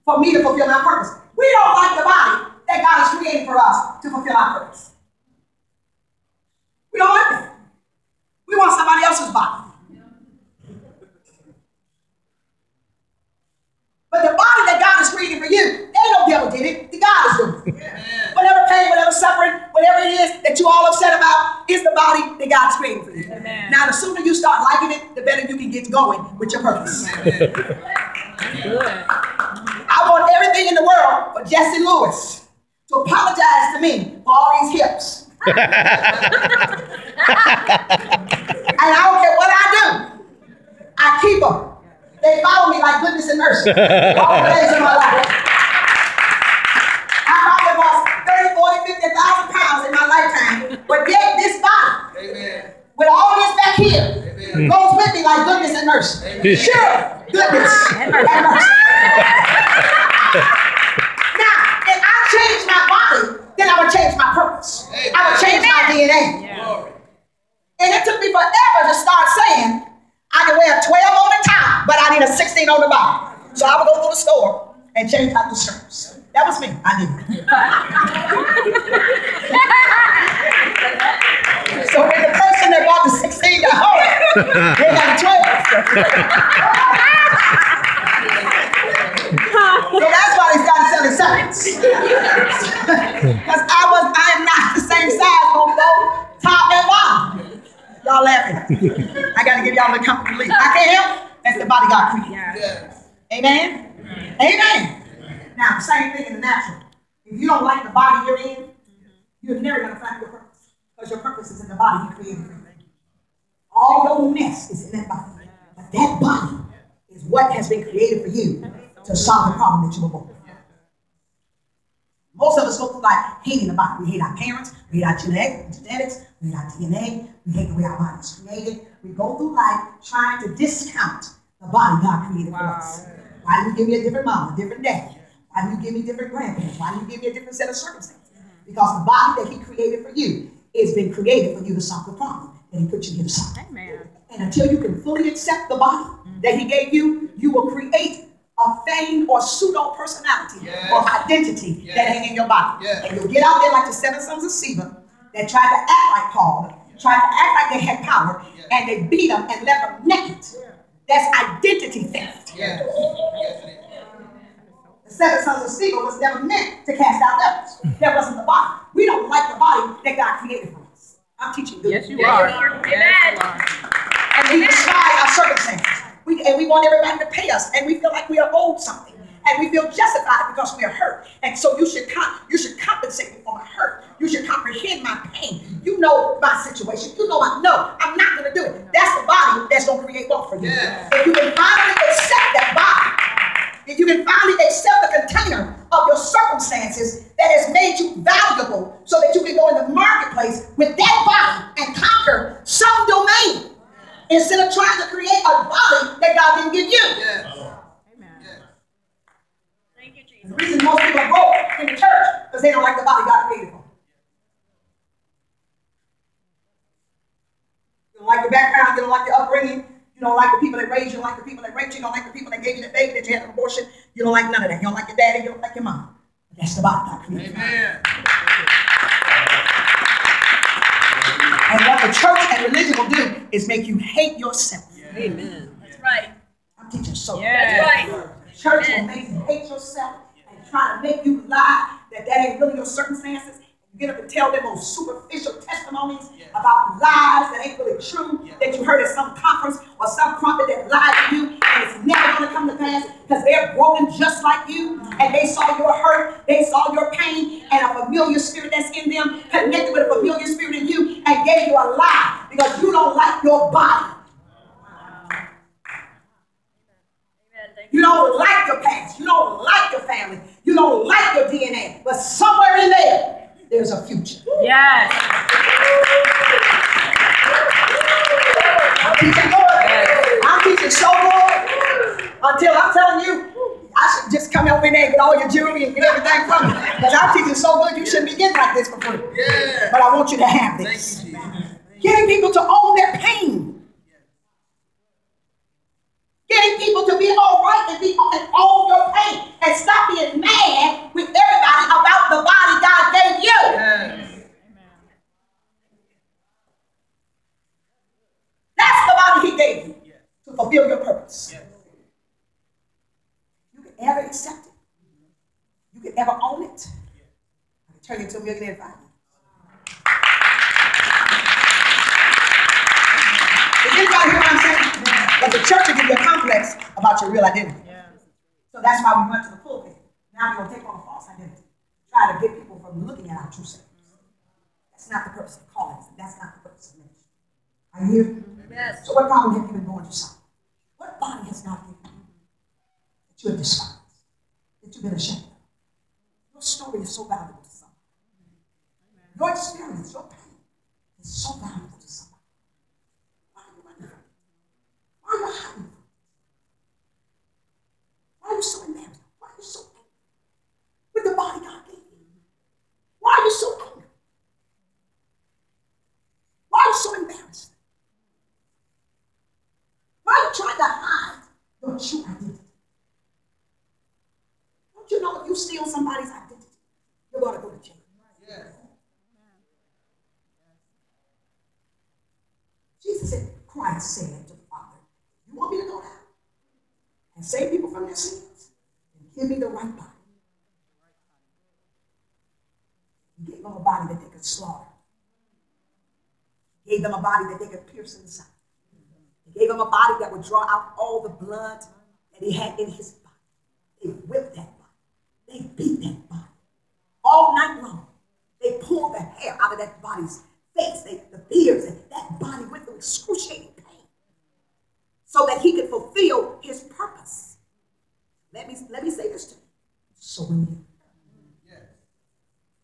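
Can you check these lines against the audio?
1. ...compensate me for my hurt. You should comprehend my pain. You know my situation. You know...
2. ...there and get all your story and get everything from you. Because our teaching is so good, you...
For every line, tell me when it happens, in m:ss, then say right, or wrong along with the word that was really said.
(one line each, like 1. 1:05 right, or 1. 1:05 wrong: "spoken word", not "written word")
1. 3:02 right
2. 4:44 wrong: "jewelry", not "story".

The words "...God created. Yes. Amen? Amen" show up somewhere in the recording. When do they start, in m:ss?
1:41.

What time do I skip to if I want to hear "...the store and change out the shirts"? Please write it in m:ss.
1:14.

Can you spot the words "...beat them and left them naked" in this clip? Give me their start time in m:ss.
2:39.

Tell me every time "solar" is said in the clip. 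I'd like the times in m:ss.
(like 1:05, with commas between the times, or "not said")
not said.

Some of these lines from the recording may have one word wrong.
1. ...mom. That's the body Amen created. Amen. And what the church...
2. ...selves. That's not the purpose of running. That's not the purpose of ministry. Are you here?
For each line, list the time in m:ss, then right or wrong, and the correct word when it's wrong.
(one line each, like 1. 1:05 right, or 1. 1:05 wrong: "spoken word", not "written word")
1. 3:45 wrong: "God", not "Amen"
2. 5:33 wrong: "calling", not "running".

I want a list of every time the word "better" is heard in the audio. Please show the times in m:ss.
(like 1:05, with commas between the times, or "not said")
0:25.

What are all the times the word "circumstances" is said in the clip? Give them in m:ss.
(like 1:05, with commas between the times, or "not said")
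2:17, 2:55, 3:16, 4:02.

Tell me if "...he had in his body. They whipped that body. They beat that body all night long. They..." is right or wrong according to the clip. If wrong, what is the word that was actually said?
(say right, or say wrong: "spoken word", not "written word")
right.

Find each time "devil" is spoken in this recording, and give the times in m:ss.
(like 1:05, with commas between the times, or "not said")
0:16, 2:47.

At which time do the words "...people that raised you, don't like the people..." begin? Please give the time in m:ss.
3:40.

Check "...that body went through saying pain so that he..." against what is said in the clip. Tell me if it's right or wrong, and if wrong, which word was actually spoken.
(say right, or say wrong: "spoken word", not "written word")
wrong: "excruciating", not "saying".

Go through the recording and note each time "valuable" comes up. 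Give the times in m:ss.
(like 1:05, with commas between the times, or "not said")
3:18, 5:47, 5:51.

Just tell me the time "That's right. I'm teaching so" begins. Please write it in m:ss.
3:55.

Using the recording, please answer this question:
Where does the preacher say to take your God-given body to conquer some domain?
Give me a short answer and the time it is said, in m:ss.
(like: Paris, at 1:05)
the marketplace, at 3:19.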